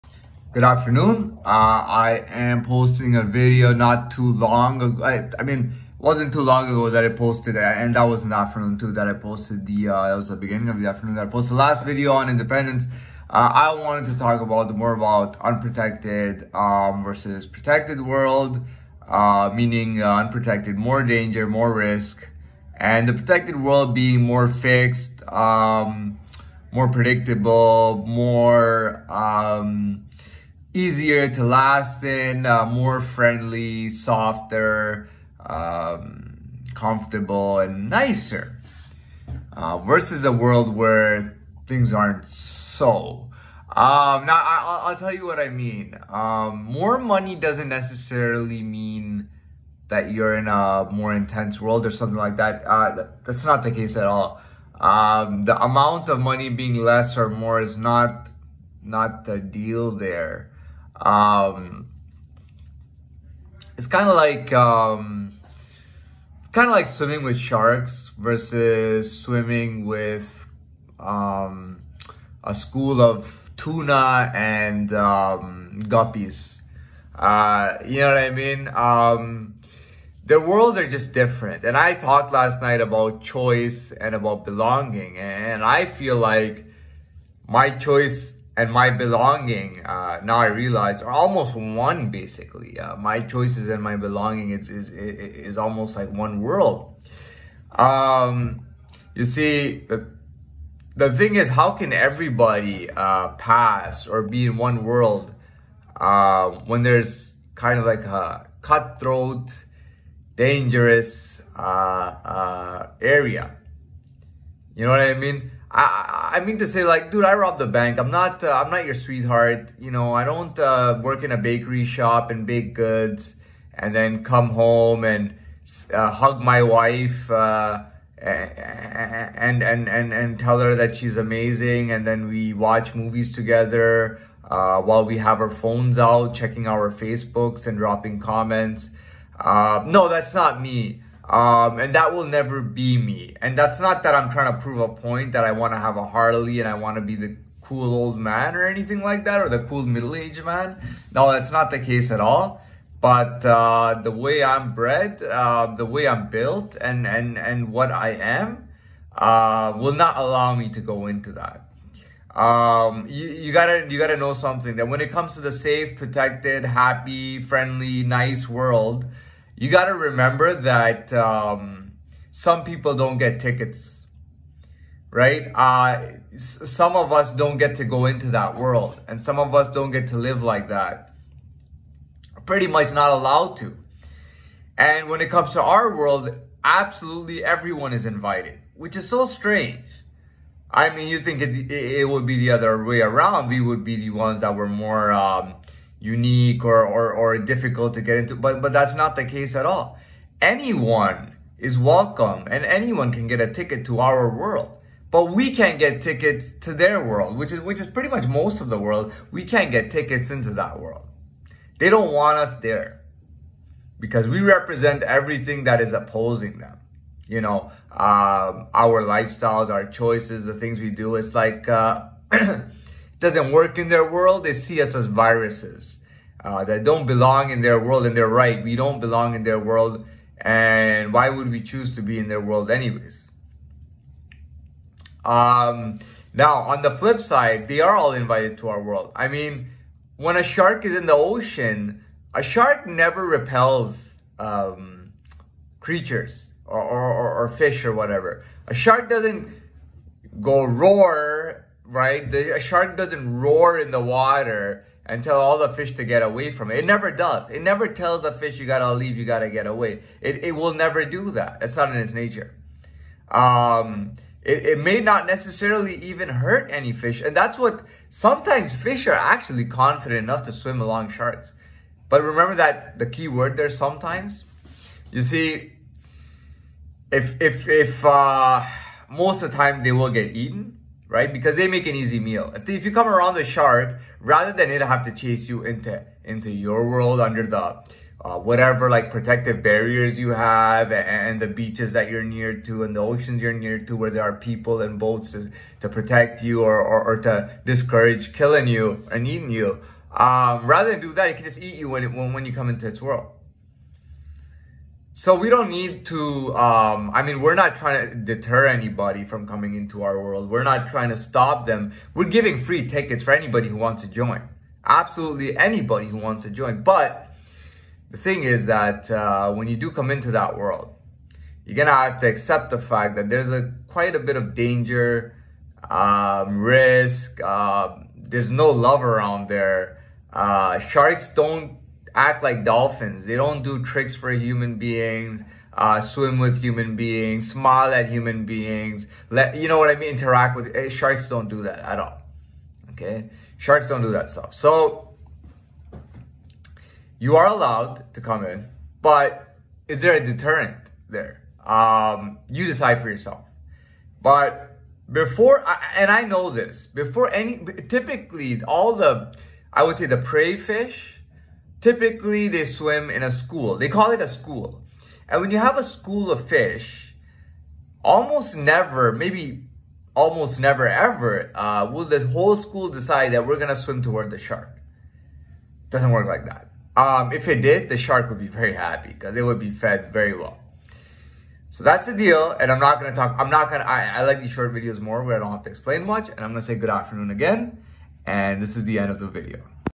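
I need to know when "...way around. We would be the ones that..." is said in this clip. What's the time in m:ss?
3:12.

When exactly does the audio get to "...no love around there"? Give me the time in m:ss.
5:28.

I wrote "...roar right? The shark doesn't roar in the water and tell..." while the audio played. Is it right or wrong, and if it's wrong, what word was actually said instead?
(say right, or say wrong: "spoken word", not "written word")
right.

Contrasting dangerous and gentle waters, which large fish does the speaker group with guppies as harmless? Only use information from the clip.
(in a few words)
tuna.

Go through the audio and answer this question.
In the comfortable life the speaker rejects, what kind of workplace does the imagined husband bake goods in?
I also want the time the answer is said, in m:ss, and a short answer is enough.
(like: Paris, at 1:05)
bakery shop, at 2:01.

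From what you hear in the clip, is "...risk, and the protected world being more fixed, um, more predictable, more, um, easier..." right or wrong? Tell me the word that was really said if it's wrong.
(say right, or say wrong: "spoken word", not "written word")
right.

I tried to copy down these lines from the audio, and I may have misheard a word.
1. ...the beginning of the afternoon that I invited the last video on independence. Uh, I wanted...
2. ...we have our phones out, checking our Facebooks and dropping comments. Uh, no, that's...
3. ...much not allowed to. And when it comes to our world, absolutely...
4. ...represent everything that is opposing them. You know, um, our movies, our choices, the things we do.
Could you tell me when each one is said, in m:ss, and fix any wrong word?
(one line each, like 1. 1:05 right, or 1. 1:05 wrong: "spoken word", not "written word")
1. 0:10 wrong: "posted", not "invited"
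2. 2:15 right
3. 3:02 right
4. 3:34 wrong: "lifestyles", not "movies".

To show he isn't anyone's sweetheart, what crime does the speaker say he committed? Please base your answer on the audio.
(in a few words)
robbed the bank.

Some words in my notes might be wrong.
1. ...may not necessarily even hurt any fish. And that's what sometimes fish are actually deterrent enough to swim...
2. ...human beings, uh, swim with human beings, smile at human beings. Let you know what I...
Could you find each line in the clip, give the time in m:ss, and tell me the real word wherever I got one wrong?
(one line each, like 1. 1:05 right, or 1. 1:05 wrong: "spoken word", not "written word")
1. 4:24 wrong: "confident", not "deterrent"
2. 5:34 right.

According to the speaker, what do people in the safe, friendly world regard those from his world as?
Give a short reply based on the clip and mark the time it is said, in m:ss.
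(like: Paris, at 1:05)
viruses, at 3:45.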